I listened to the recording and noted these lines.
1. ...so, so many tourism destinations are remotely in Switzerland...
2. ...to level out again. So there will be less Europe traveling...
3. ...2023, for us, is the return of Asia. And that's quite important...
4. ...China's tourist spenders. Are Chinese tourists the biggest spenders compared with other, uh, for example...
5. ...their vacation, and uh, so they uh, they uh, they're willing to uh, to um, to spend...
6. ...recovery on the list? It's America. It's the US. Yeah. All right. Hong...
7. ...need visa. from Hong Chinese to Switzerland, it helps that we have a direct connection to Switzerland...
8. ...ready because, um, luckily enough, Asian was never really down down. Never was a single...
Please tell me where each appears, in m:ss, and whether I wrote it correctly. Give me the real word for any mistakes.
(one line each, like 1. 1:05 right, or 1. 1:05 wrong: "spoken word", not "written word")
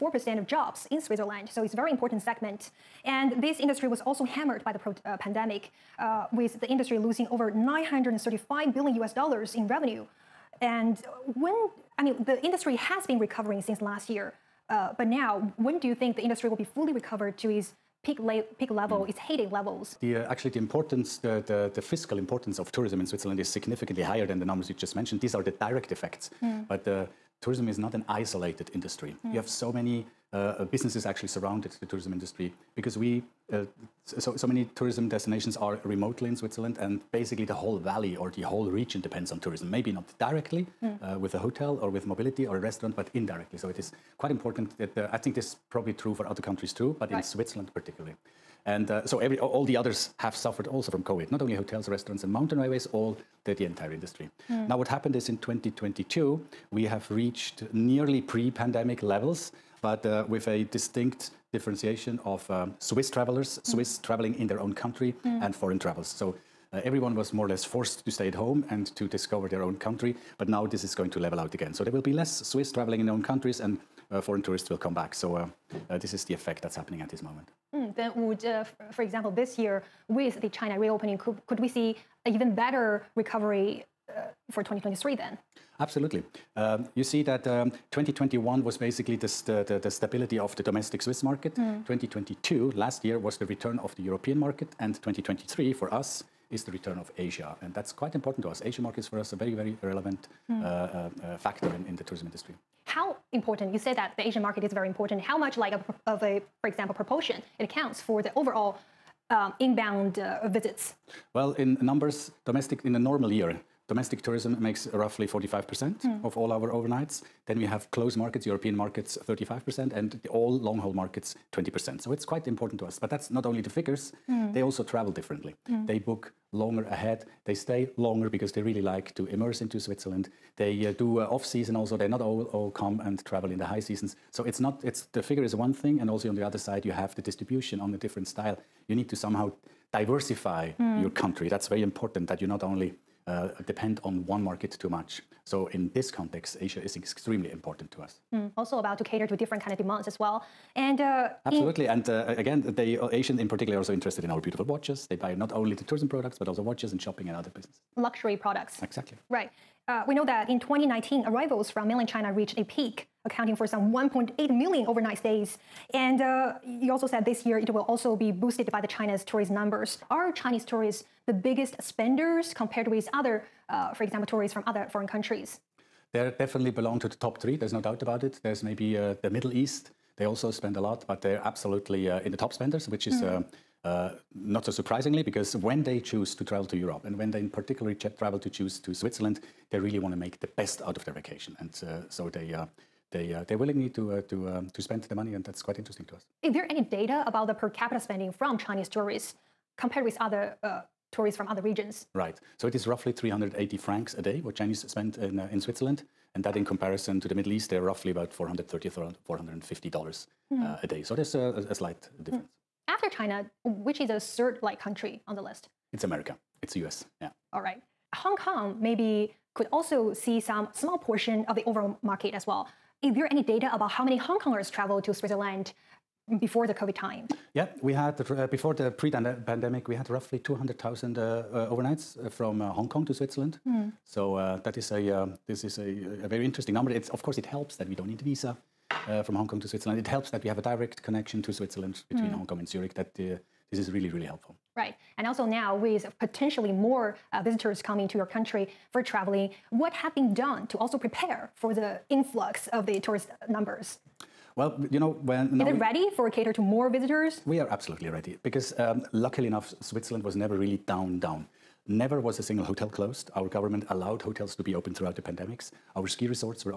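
1. 0:34 right
2. 1:11 wrong: "Swiss", not "Europe"
3. 1:35 right
4. 2:48 wrong: "numbers", not "spenders"
5. 3:11 right
6. 3:34 wrong: "country", not "recovery"
7. 3:58 wrong: "Kong", not "Chinese"
8. 4:18 wrong: "Switzerland", not "Asian".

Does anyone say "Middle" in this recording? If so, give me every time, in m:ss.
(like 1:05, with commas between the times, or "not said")
2:59, 3:27.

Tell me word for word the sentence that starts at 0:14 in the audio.
Uh, but now, when do you think the industry will be fully recovered to its peak, peak level, mm.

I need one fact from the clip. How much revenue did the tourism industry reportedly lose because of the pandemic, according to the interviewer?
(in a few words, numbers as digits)
935 billion US dollars.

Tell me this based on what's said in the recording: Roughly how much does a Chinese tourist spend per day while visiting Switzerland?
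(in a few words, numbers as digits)
380 francs.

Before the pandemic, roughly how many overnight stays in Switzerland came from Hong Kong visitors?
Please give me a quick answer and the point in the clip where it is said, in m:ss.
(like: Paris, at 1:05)
200,000, at 3:50.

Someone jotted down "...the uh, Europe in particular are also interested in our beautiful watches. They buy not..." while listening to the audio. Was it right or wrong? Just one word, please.
wrong.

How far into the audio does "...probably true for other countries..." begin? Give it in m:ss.
0:45.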